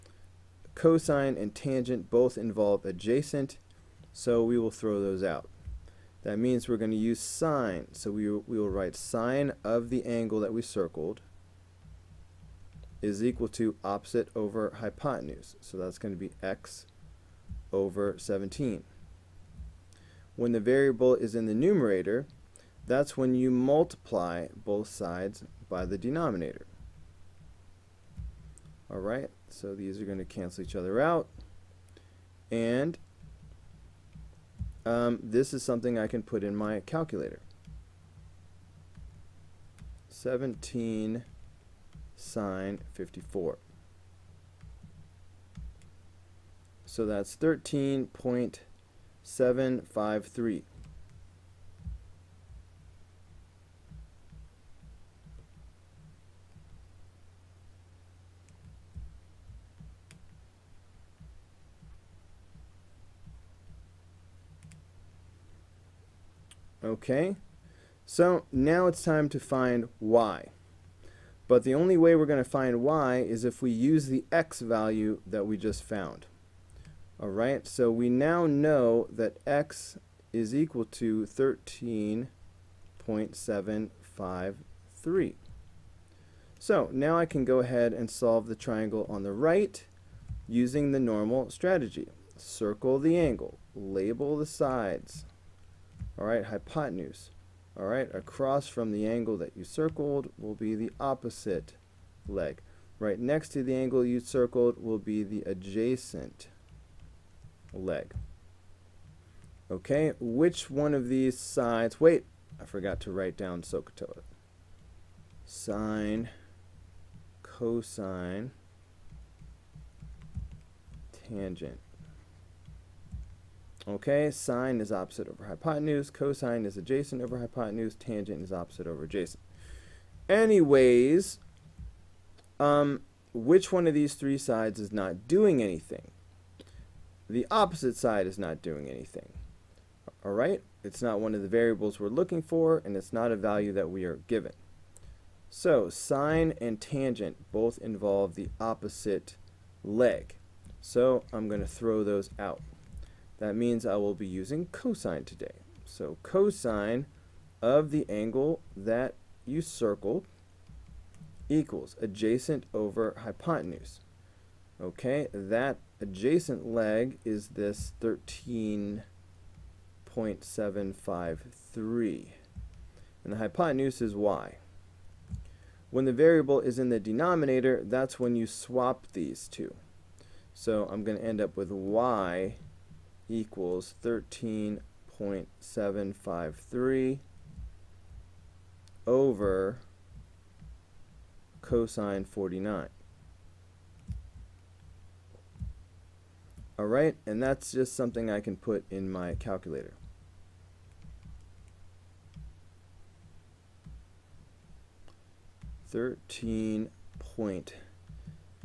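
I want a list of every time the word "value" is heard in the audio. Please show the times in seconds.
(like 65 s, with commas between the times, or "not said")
74 s, 143 s.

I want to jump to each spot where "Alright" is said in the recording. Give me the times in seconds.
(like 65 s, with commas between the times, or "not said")
28 s, 77 s, 196 s.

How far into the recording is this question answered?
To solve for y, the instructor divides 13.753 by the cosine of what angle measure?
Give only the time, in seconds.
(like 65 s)
191 s.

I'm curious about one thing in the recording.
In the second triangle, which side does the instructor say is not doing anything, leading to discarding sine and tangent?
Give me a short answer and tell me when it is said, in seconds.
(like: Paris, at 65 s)
The opposite side, at 137 s.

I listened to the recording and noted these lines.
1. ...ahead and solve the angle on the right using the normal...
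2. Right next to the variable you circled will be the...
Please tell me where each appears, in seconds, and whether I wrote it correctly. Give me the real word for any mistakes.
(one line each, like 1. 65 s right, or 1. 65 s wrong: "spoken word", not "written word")
1. 87 s wrong: "triangle", not "angle"
2. 102 s wrong: "angle", not "variable".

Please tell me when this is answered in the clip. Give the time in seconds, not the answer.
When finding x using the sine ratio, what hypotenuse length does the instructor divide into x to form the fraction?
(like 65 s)
16 s.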